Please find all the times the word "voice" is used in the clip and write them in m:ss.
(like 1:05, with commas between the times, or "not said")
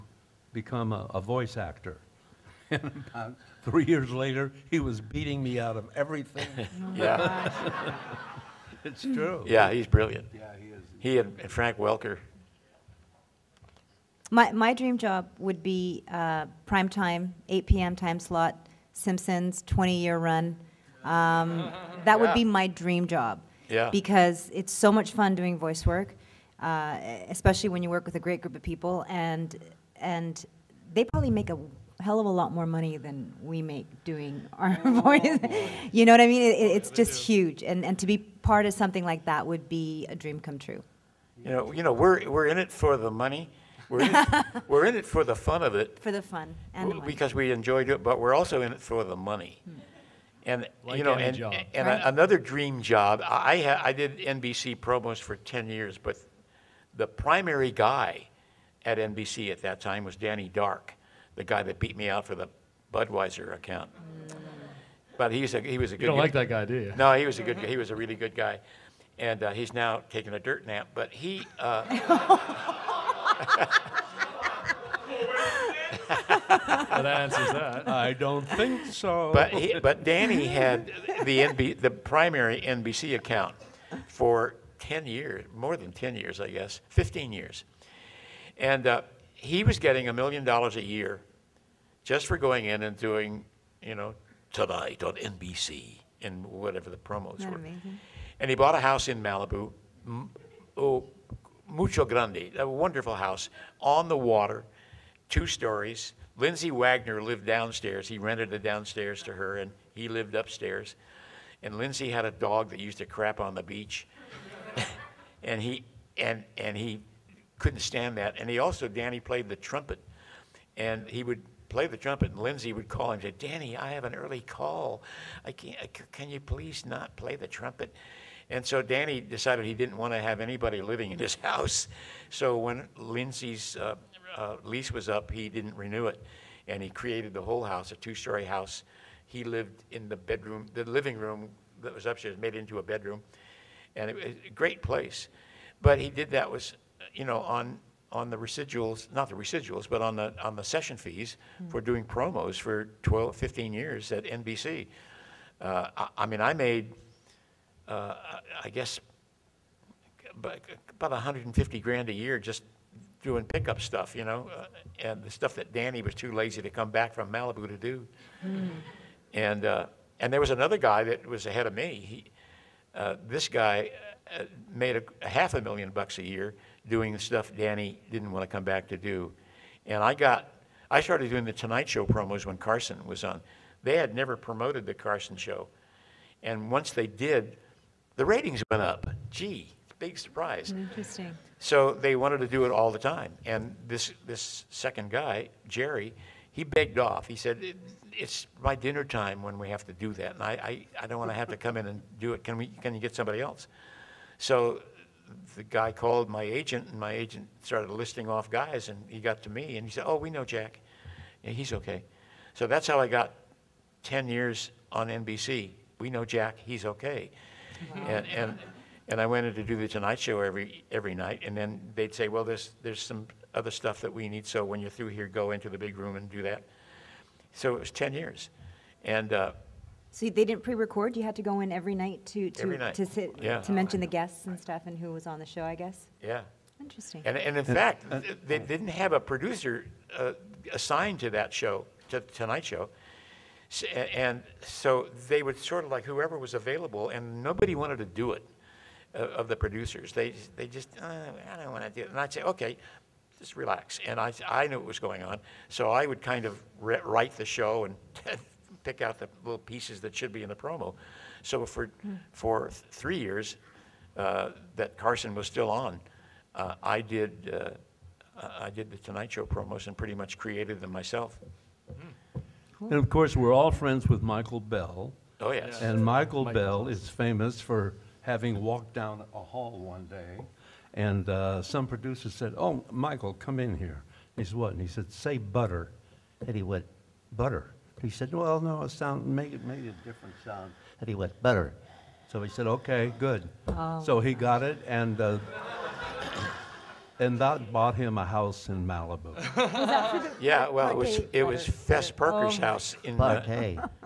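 0:01, 0:25, 0:35.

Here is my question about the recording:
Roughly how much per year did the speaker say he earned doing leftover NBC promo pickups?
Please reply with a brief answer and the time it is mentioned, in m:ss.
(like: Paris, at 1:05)
150 grand, at 2:41.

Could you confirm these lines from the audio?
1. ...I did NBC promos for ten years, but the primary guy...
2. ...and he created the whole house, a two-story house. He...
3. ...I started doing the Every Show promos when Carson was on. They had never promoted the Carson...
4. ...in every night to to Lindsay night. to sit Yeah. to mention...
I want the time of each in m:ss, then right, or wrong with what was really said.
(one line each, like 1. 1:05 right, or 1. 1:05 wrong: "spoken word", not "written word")
1. 0:53 right
2. 2:16 right
3. 3:00 wrong: "Tonight", not "Every"
4. 3:51 wrong: "Every", not "Lindsay".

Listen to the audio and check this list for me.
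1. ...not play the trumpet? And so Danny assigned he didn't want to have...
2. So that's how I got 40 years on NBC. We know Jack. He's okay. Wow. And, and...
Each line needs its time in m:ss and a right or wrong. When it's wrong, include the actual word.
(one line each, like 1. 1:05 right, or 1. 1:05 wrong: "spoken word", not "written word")
1. 2:06 wrong: "decided", not "assigned"
2. 3:32 wrong: "10", not "40".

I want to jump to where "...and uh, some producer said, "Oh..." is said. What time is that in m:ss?
4:40.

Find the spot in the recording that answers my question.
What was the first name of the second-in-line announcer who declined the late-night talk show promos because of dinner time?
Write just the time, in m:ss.
3:15.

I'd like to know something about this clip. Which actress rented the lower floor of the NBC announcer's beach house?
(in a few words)
Lindsay Wagner.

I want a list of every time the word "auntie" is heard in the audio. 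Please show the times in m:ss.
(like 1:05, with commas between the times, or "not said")
not said.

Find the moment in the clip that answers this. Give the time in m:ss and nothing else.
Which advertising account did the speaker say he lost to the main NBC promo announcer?
1:02.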